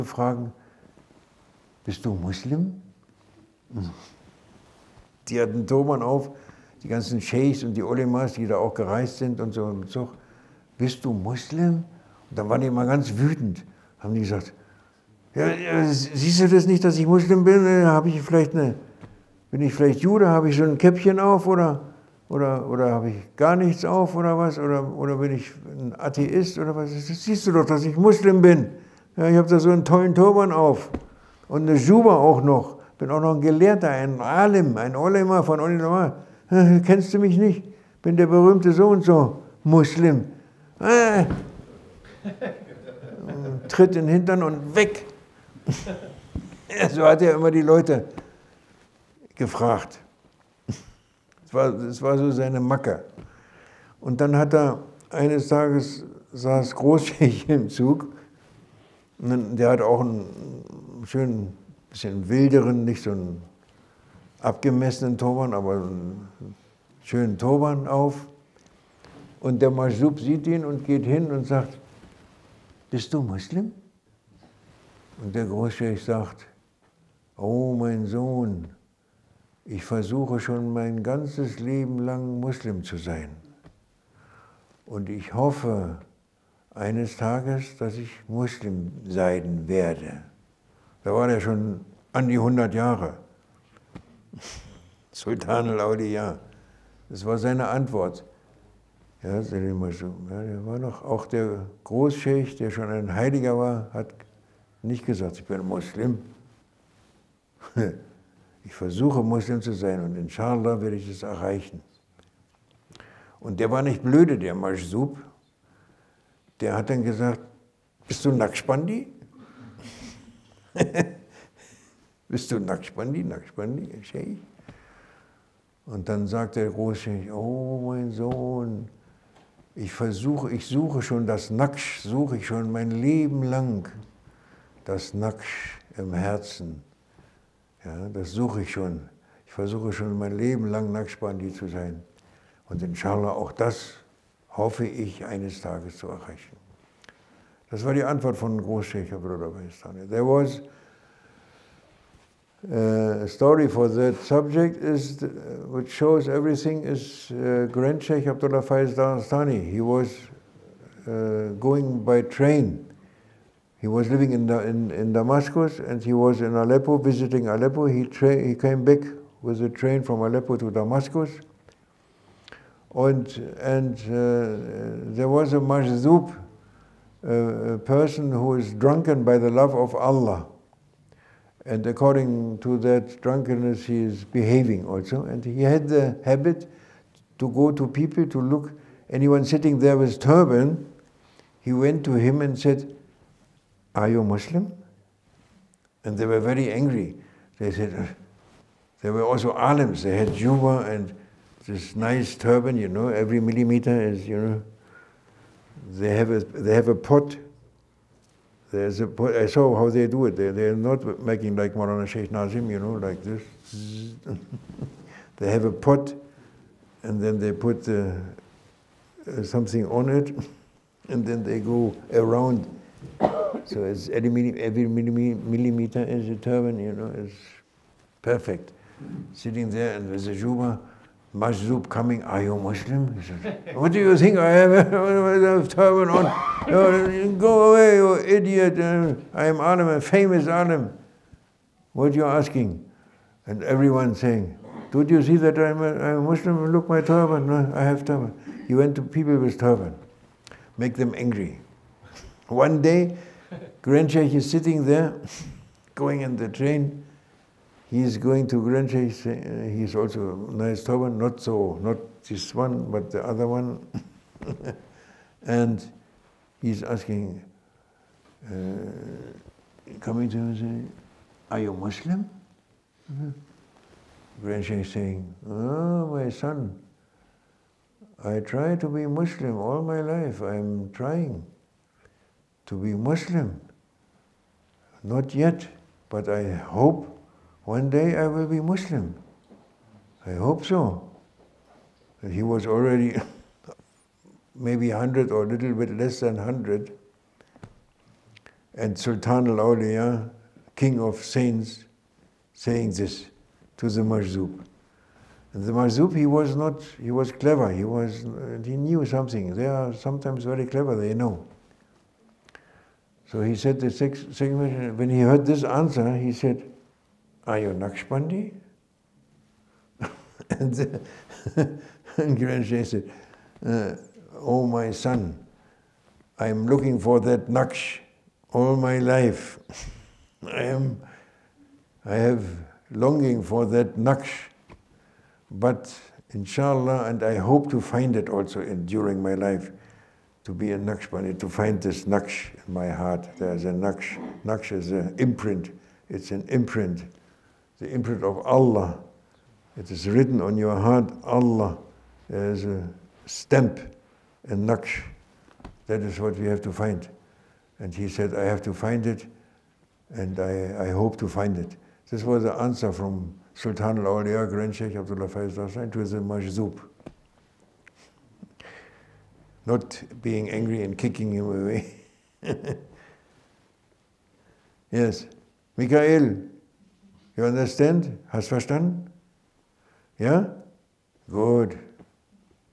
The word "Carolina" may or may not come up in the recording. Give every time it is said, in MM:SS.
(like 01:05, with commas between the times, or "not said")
not said.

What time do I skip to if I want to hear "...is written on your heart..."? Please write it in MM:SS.
05:49.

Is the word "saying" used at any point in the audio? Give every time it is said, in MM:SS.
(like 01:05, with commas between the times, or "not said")
04:04, 04:30, 04:34, 05:02.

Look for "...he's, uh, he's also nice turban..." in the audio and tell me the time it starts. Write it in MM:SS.
04:18.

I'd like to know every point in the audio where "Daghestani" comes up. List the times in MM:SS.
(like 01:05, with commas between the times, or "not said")
02:38, 06:05.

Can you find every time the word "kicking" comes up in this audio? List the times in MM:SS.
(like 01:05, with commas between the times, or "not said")
06:10.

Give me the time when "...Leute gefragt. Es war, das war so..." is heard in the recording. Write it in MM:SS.
00:47.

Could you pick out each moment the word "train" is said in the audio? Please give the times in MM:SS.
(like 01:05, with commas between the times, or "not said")
02:42, 02:49, 04:16.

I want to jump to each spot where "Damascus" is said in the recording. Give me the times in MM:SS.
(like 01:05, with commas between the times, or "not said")
02:45, 02:50.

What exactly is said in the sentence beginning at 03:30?
They, they're not making like Marana Sheikh Nazim, you know, like this.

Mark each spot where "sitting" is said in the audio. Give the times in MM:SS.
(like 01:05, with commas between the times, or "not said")
03:09, 03:49, 04:14.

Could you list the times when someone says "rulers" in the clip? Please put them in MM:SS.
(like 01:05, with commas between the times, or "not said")
not said.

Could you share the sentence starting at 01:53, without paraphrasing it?
Und der war nicht blöde, der Masjub.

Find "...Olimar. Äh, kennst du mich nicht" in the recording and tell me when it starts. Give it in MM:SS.
00:35.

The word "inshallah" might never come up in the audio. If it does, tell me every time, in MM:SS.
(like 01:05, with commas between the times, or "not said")
01:50, 02:22, 05:36.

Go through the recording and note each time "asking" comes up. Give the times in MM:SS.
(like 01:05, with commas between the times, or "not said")
04:02, 04:26.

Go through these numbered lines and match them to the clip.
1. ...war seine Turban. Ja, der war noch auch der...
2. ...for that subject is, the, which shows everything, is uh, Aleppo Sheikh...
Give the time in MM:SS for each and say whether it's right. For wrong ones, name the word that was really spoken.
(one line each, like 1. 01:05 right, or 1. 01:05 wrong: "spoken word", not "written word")
1. 01:37 wrong: "Antwort", not "Turban"
2. 02:33 wrong: "Grand", not "Aleppo".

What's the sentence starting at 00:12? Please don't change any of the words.
Und dann waren die immer ganz wütend, haben die gesagt, ja, ja, siehst du das nicht, dass ich Muslim bin?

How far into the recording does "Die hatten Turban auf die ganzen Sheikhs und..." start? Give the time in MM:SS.
00:05.